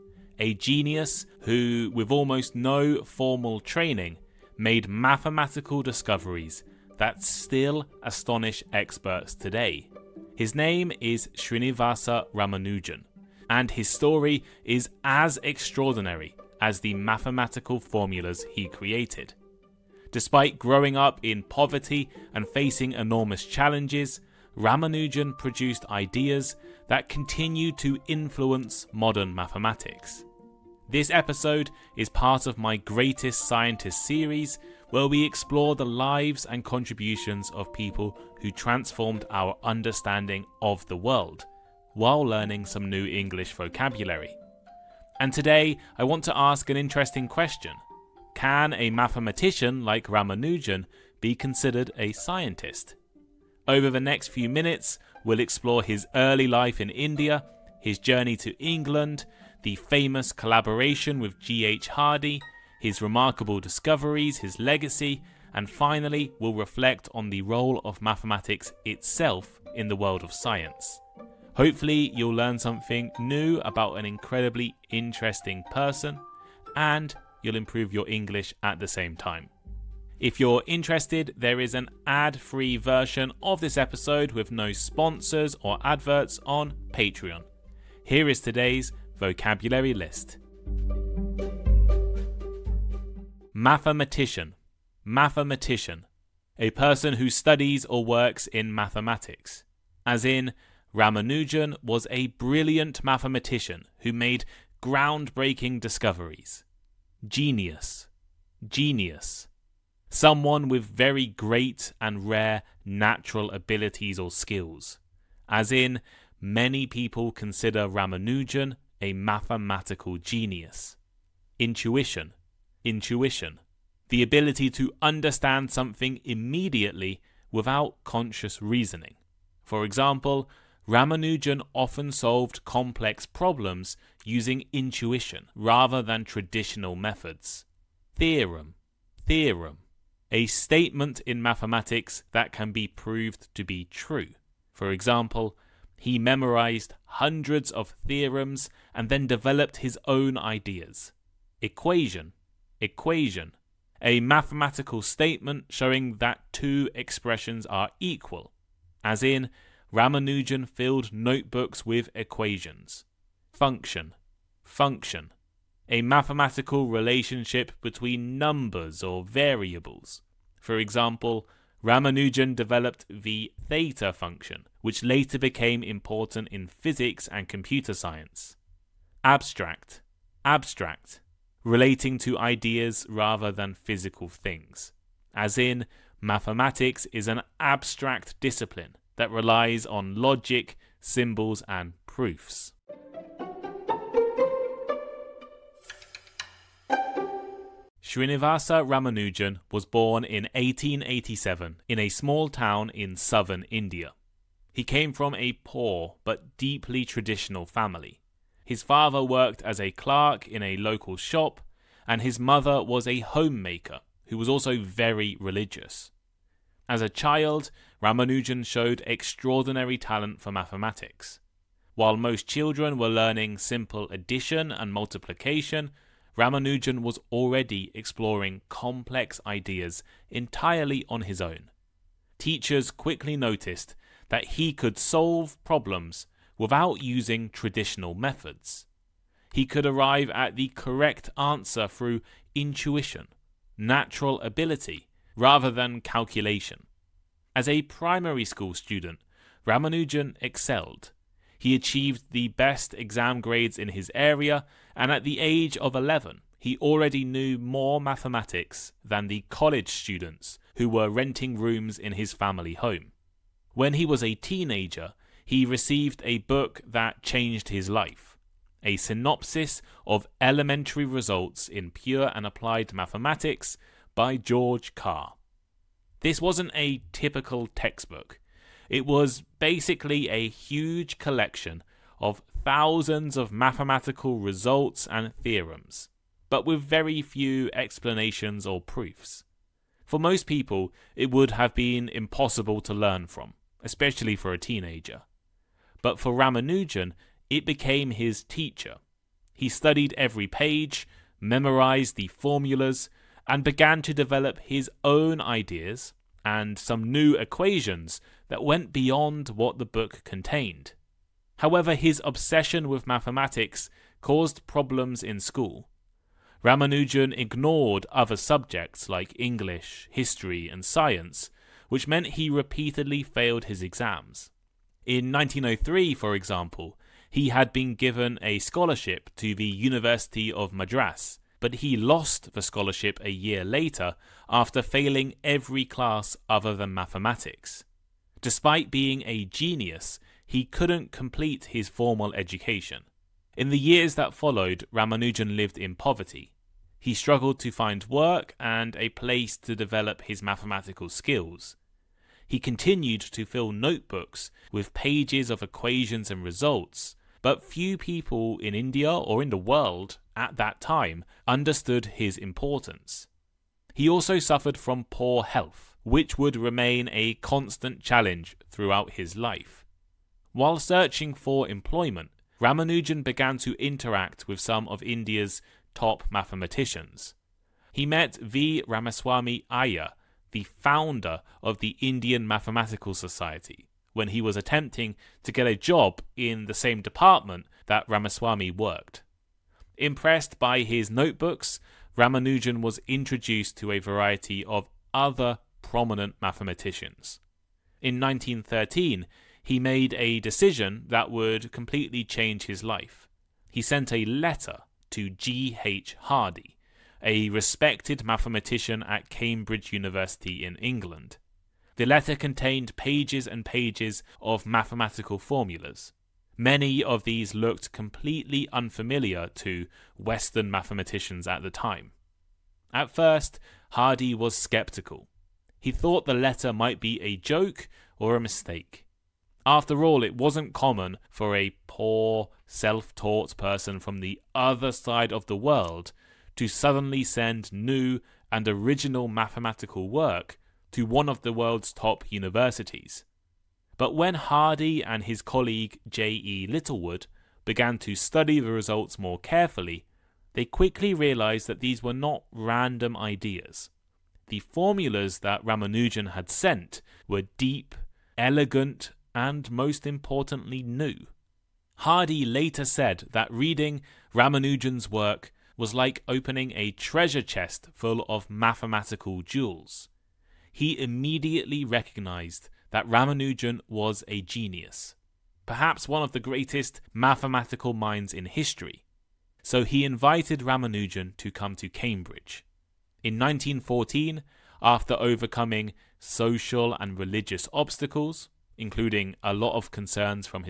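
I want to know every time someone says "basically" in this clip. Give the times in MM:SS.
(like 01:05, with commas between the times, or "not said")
04:39.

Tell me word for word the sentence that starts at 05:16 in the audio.
Ramanujan ignored other subjects like English, history, and science, which meant he repeatedly failed his exams.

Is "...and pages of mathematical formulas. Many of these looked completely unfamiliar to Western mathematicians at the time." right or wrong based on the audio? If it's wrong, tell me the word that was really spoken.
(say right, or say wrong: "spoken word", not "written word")
right.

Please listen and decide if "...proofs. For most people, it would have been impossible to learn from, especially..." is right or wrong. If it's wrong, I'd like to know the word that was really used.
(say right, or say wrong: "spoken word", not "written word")
right.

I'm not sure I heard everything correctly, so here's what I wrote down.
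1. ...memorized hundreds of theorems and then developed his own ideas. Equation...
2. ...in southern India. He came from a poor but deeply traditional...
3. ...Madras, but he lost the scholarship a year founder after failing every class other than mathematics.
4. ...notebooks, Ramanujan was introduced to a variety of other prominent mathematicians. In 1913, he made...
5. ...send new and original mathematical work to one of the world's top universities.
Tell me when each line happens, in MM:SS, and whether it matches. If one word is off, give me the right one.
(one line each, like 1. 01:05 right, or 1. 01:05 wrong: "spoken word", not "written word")
1. 02:26 right
2. 03:22 right
3. 05:30 wrong: "later", not "founder"
4. 06:31 right
5. 07:17 right.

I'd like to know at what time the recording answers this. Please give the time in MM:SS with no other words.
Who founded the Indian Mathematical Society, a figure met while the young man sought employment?
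06:18.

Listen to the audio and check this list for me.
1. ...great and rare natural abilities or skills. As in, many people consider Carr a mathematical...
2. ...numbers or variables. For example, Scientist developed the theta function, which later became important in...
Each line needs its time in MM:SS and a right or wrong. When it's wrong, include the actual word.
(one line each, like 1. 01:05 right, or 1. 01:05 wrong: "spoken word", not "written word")
1. 01:51 wrong: "Ramanujan", not "Carr"
2. 02:48 wrong: "Ramanujan", not "Scientist".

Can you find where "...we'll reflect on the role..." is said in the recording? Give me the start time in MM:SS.
01:06.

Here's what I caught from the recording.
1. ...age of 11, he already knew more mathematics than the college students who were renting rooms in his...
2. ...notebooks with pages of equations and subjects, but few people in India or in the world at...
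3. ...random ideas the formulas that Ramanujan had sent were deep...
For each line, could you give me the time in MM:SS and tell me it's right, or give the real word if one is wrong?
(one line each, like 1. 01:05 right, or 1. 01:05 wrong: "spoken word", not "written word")
1. 04:15 right
2. 05:53 wrong: "results", not "subjects"
3. 07:32 right.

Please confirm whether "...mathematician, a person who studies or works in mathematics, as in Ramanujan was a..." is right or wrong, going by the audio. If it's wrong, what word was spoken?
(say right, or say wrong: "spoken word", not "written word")
right.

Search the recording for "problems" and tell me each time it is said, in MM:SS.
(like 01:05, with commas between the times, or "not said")
02:13, 03:55, 05:14.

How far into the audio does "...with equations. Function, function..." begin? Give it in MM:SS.
02:41.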